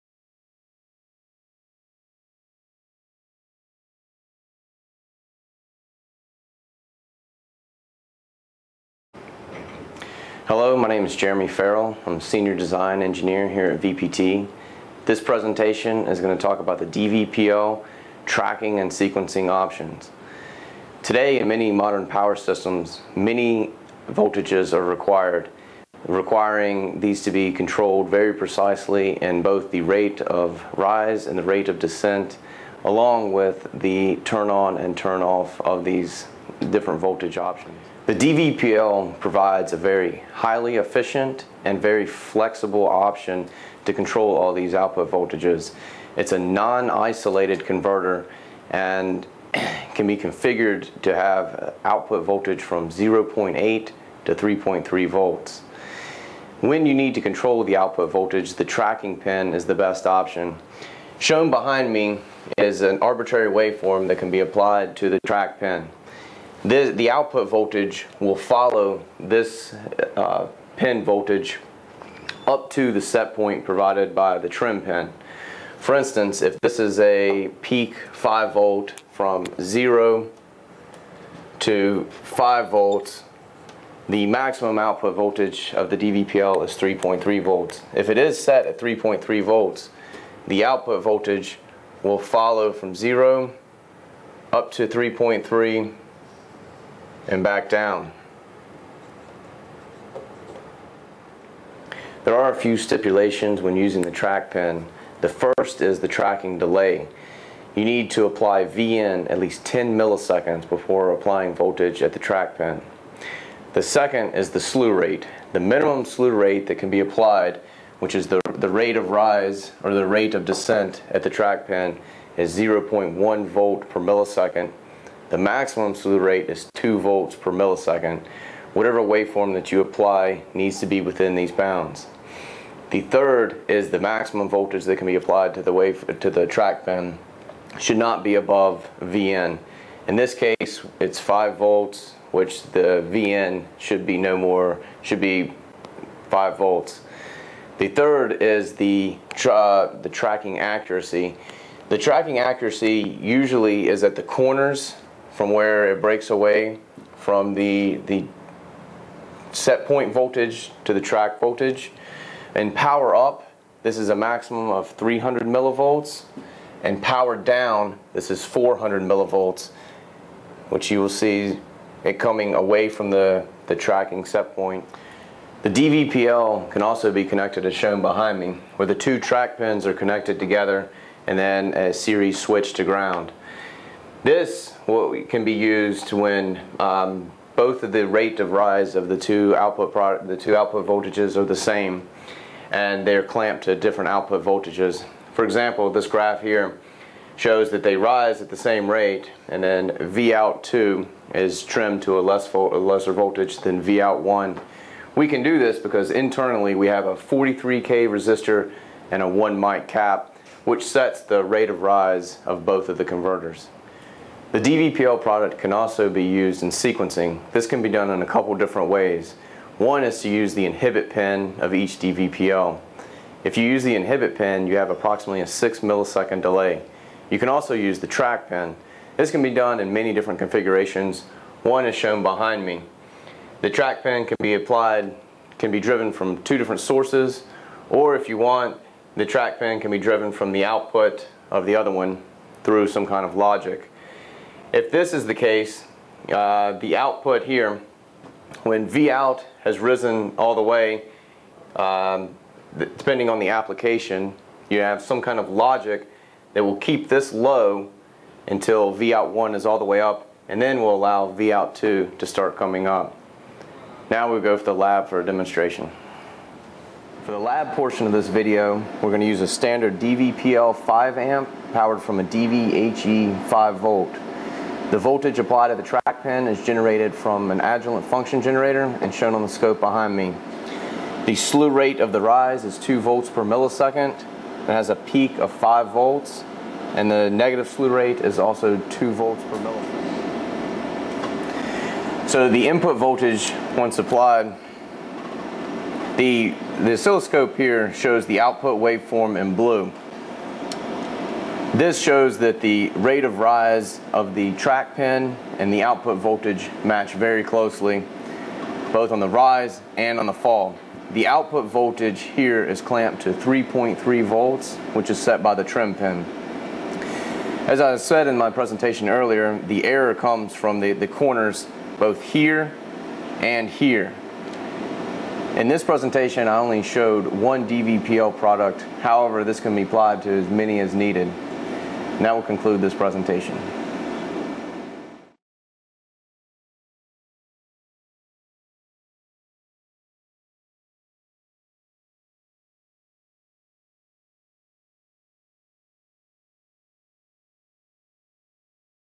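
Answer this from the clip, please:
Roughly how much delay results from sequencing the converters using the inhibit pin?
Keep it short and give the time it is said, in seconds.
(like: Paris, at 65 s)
6 milliseconds, at 225 s.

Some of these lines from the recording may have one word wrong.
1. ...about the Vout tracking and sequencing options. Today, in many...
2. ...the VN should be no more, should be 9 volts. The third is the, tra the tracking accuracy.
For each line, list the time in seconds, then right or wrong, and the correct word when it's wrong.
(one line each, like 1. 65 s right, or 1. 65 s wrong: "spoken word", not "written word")
1. 16 s wrong: "DVPL", not "Vout"
2. 142 s wrong: "5", not "9".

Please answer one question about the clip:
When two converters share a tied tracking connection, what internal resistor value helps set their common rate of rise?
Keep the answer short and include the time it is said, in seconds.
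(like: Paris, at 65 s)
43K, at 207 s.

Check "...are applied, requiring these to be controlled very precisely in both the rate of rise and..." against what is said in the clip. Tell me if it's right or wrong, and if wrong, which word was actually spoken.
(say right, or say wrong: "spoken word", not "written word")
wrong: "required", not "applied".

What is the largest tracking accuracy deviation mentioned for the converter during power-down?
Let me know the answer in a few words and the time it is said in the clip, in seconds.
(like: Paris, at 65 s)
400 millivolts, at 168 s.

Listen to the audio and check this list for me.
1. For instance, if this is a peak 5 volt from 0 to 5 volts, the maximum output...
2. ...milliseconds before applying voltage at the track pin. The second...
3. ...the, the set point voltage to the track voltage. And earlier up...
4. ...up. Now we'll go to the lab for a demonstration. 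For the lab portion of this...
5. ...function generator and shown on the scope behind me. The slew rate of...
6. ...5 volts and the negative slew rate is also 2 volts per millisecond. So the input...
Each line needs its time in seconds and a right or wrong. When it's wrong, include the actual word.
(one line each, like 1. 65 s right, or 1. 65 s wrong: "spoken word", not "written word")
1. 75 s right
2. 109 s right
3. 157 s wrong: "power", not "earlier"
4. 262 s right
5. 278 s right
6. 285 s right.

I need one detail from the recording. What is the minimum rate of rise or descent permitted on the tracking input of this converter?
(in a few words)
0.1 volt per millisecond.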